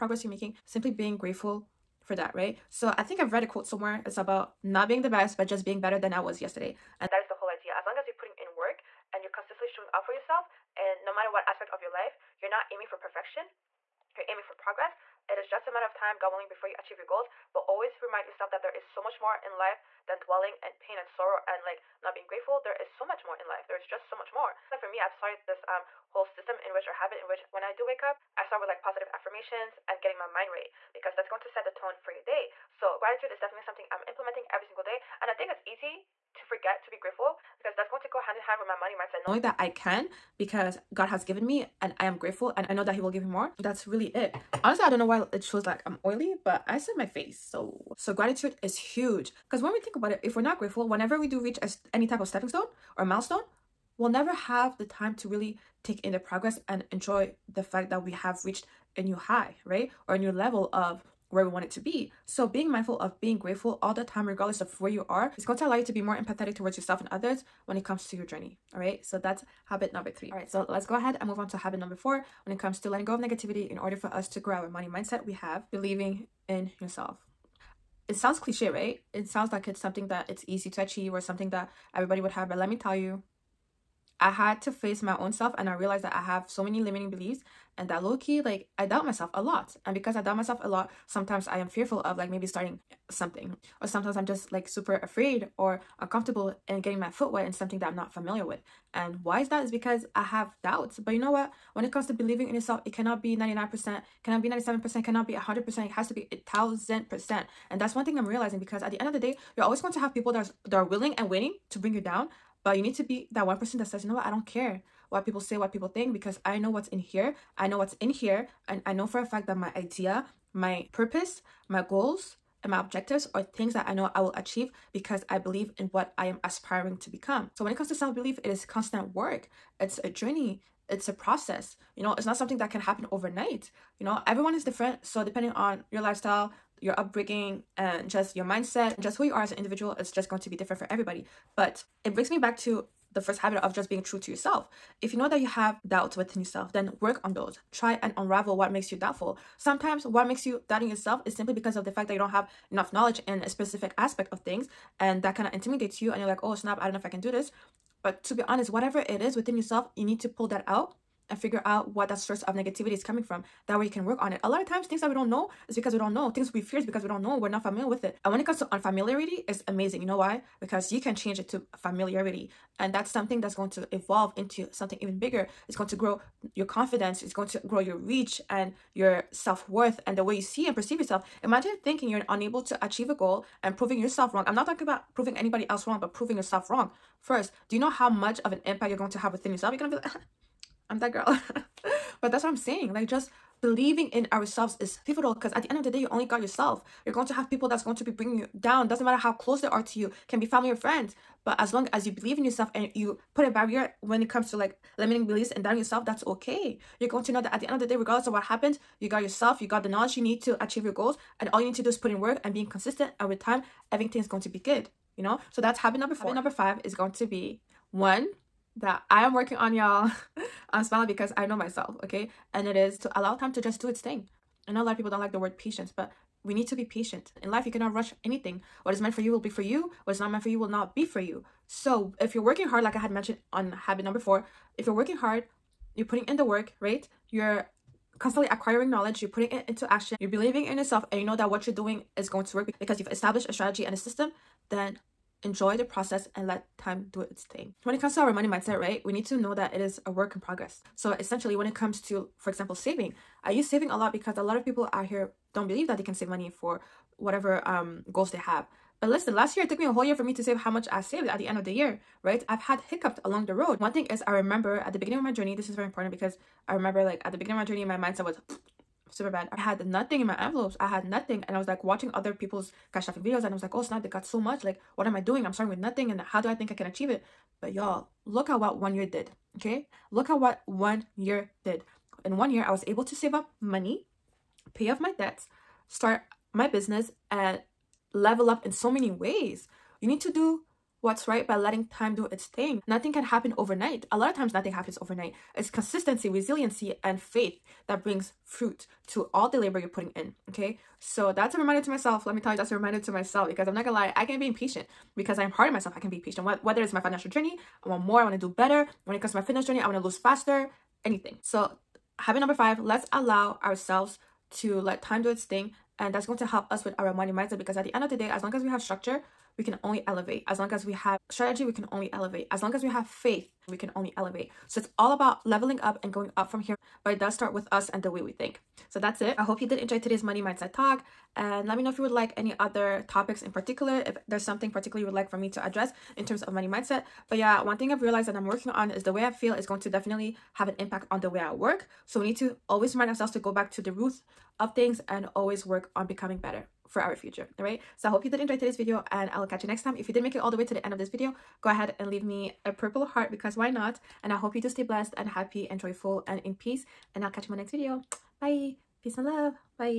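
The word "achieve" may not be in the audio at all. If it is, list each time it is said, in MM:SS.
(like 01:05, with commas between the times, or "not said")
00:16, 01:20, 02:04, 03:02, 03:30, 04:36.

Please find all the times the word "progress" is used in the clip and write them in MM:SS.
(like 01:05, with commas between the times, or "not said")
00:14, 00:56, 04:10.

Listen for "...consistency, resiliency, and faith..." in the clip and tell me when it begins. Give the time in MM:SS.
04:55.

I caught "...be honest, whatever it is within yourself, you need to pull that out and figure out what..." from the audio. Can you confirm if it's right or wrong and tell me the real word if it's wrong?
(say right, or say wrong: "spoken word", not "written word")
right.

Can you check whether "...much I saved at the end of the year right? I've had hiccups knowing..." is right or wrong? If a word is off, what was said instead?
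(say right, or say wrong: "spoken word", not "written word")
wrong: "along", not "knowing".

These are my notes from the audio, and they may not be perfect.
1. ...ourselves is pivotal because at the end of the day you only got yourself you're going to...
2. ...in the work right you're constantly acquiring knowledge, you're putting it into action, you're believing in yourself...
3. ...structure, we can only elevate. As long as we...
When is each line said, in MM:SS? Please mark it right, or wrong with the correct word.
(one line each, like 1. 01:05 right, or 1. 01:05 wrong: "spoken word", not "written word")
1. 03:14 right
2. 03:56 right
3. 05:18 right.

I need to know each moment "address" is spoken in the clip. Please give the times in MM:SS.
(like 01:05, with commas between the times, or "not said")
05:35.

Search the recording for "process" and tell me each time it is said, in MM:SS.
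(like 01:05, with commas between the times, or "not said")
02:11, 04:05.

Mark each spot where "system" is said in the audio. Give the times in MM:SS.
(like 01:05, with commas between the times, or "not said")
00:26, 04:03.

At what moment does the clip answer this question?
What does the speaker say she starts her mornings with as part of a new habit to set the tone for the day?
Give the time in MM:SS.
00:28.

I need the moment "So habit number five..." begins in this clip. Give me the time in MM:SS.
05:11.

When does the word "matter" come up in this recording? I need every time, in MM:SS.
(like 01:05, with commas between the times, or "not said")
00:11, 00:15, 03:19.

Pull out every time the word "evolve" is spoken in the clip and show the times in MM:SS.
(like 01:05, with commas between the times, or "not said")
02:53.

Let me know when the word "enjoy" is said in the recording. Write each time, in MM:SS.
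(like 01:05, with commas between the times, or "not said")
00:56, 04:05, 05:29, 05:48.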